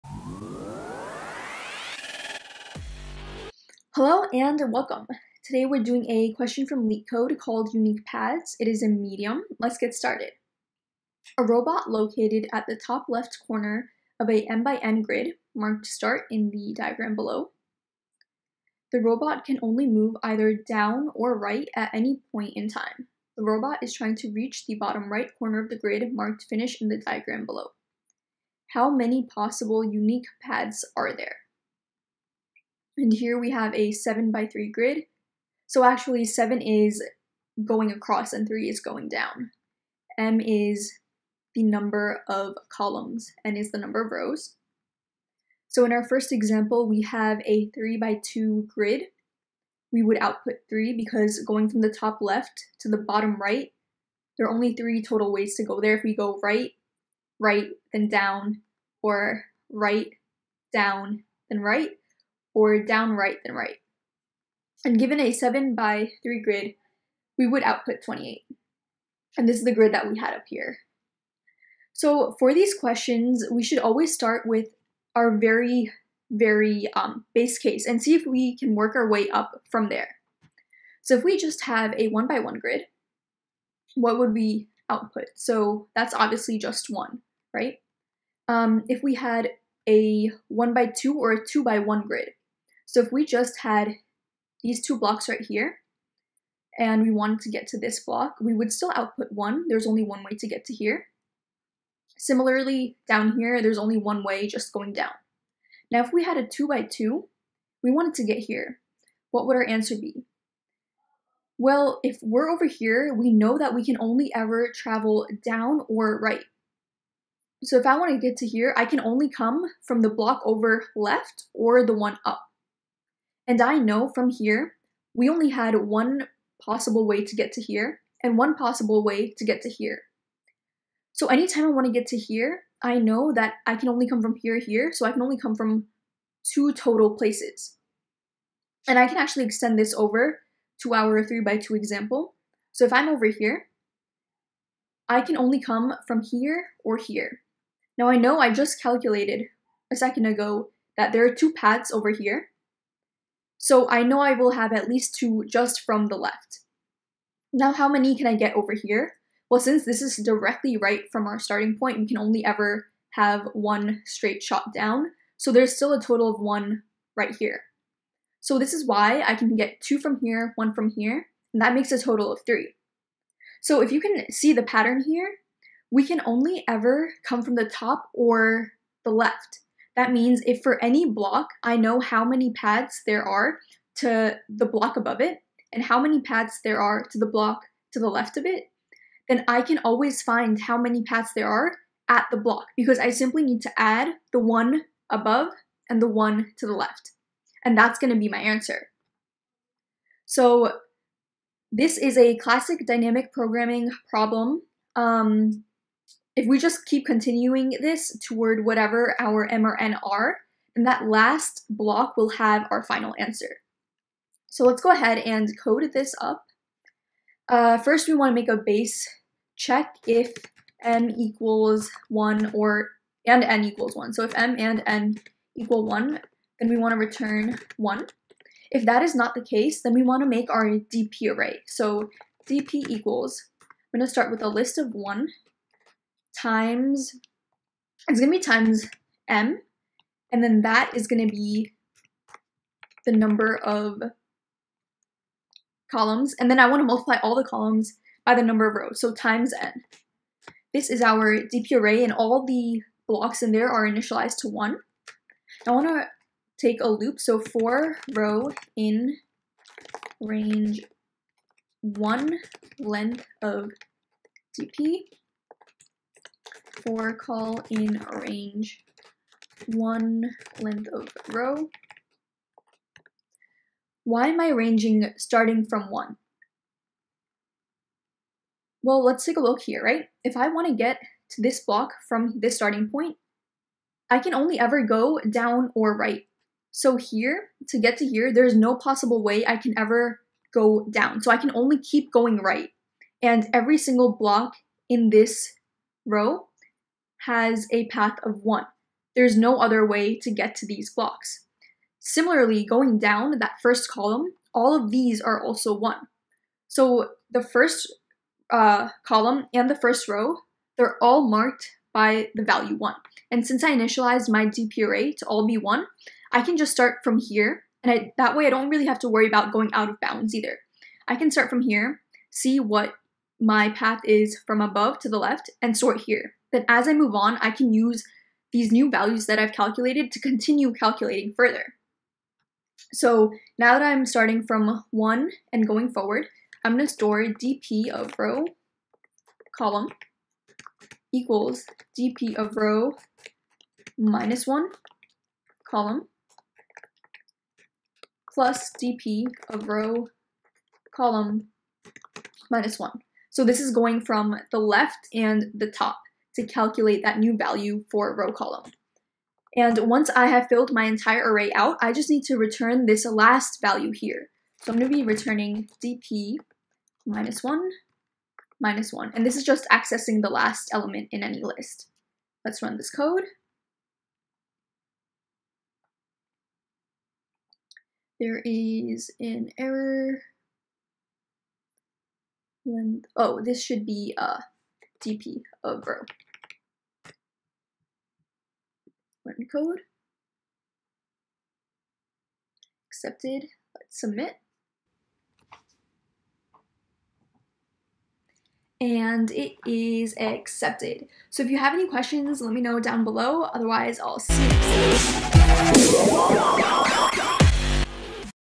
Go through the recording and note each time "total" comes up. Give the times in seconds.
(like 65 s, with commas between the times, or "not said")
55 s, 136 s, 166 s, 172 s.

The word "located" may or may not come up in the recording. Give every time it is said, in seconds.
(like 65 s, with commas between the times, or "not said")
11 s.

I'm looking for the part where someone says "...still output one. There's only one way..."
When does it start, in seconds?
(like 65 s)
98 s.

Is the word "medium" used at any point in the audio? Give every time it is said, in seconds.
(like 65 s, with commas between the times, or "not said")
8 s.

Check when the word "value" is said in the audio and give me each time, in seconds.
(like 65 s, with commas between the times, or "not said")
312 s, 328 s, 357 s, 363 s.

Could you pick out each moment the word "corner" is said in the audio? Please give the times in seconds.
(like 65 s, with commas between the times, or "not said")
13 s, 25 s.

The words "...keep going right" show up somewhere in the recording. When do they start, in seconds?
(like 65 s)
291 s.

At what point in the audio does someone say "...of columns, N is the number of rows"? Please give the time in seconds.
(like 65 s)
42 s.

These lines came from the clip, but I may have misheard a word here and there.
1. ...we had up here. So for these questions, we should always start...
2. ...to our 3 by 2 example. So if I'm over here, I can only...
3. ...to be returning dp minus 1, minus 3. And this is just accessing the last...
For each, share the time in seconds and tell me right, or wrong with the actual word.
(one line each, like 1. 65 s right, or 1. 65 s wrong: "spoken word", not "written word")
1. 70 s right
2. 140 s right
3. 364 s wrong: "1", not "3".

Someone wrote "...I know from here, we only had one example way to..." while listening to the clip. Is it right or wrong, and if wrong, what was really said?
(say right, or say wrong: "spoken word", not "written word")
wrong: "possible", not "example".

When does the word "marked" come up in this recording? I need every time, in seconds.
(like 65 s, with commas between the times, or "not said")
15 s, 26 s, 311 s.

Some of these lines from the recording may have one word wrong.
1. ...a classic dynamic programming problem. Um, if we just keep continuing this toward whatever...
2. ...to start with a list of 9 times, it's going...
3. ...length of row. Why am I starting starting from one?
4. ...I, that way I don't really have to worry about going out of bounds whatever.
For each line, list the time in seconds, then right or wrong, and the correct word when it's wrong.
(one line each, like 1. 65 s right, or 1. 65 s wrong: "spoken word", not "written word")
1. 202 s right
2. 234 s wrong: "1", not "9"
3. 270 s wrong: "ranging", not "starting"
4. 317 s wrong: "either", not "whatever".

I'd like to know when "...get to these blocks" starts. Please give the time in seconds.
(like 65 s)
300 s.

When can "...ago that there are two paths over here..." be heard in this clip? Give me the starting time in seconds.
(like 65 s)
150 s.